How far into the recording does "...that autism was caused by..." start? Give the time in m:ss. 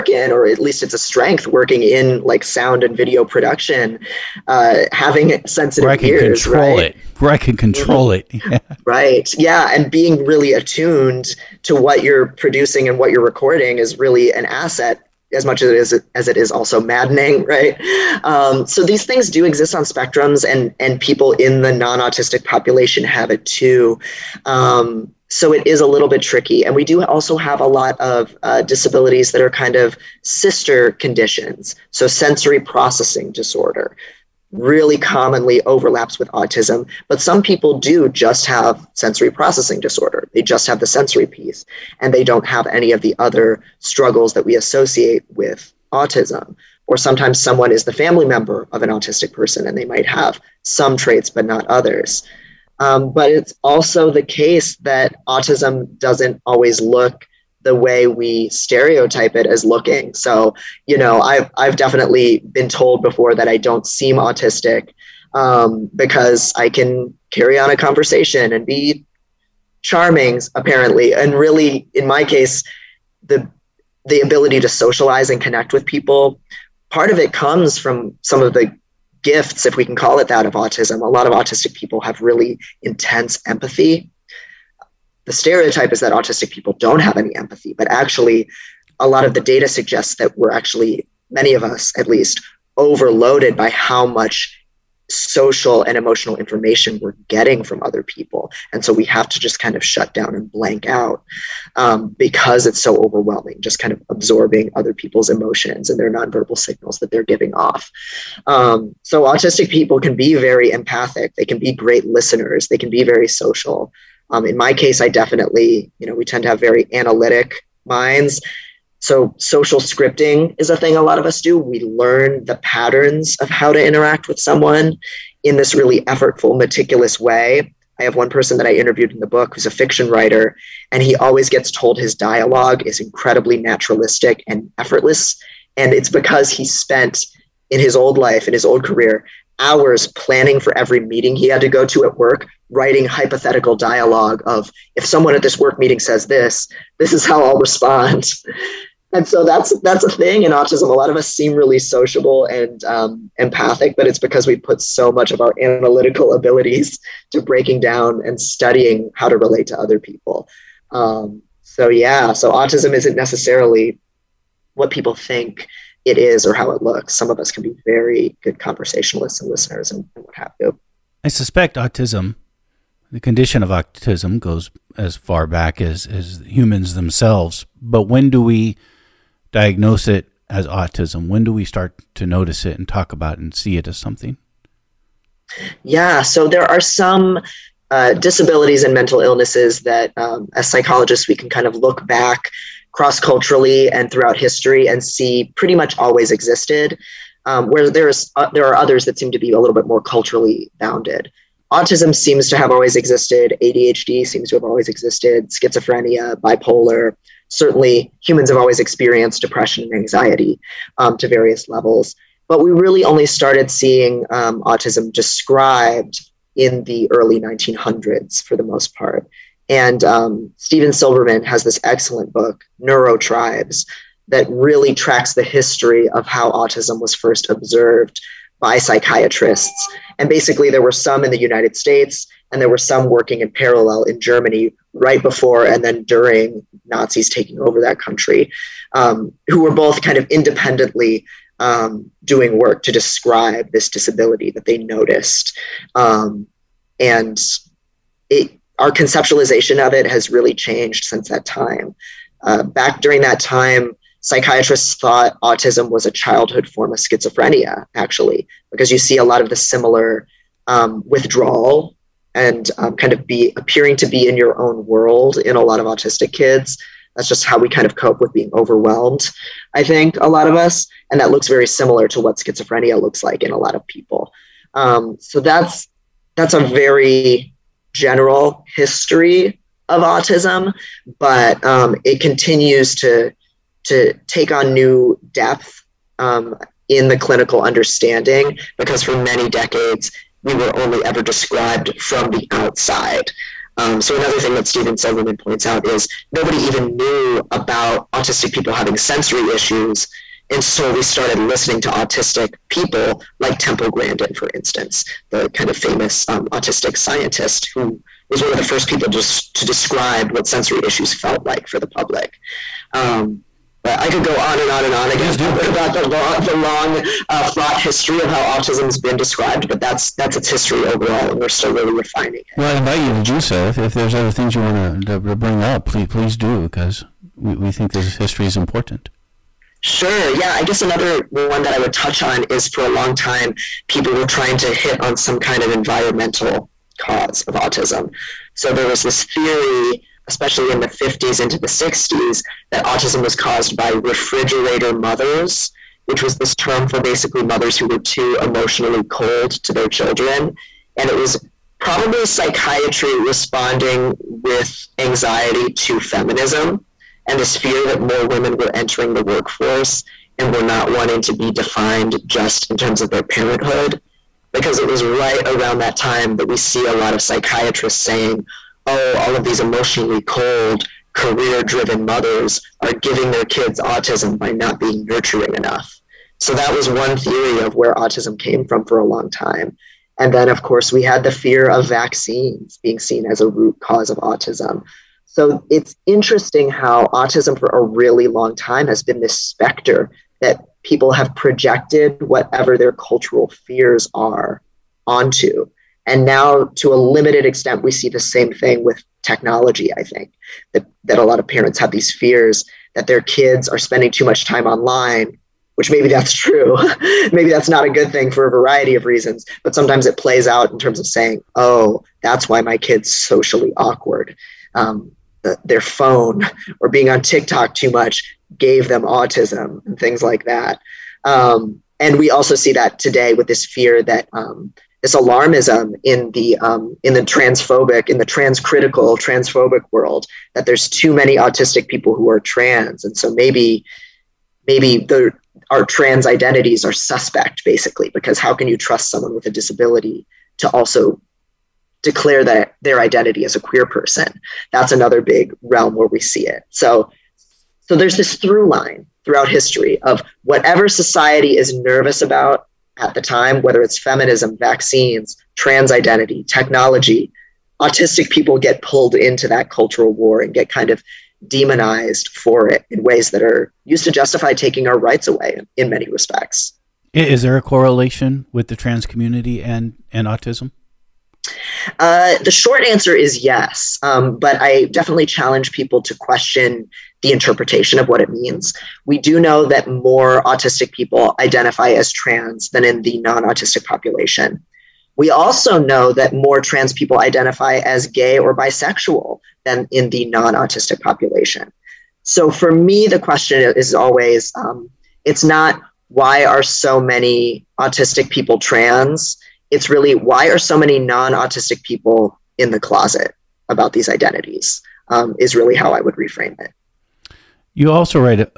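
5:42.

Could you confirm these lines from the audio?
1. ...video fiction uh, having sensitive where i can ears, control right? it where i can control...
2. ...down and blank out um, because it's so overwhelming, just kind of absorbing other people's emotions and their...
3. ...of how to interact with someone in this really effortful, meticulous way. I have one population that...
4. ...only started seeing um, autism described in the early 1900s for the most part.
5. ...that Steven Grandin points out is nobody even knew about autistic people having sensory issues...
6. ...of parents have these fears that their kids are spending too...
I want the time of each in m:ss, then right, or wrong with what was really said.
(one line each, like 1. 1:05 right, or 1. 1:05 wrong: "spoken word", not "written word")
1. 0:02 wrong: "production", not "fiction"
2. 1:40 right
3. 2:03 wrong: "person", not "population"
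4. 3:33 right
5. 4:54 wrong: "Silberman", not "Grandin"
6. 6:41 right.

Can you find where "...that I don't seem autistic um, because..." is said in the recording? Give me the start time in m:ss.
1:03.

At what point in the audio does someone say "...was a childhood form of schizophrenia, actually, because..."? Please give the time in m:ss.
4:15.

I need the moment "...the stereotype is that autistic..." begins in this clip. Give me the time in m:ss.
1:25.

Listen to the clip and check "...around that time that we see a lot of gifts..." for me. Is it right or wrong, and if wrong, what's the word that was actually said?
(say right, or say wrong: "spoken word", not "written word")
wrong: "psychiatrists", not "gifts".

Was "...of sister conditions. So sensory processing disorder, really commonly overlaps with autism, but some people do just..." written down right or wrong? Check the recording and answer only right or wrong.
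right.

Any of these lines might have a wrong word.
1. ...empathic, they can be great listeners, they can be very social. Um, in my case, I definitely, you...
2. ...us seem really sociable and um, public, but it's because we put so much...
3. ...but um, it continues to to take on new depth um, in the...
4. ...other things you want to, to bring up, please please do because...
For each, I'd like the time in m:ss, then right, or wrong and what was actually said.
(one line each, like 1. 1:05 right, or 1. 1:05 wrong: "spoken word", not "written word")
1. 1:50 right
2. 2:31 wrong: "empathic", not "public"
3. 4:41 right
4. 5:24 right.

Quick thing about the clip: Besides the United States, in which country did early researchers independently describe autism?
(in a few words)
Germany.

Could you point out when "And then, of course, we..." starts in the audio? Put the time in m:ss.
6:20.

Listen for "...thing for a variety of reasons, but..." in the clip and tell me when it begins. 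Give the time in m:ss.
6:48.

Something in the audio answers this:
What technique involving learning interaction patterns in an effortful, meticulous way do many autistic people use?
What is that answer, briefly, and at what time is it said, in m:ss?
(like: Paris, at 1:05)
Social scripting, at 1:59.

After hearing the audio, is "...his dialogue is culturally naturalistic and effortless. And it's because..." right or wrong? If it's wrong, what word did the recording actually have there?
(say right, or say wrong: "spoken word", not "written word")
wrong: "incredibly", not "culturally".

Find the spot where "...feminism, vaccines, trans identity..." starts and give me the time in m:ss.
7:33.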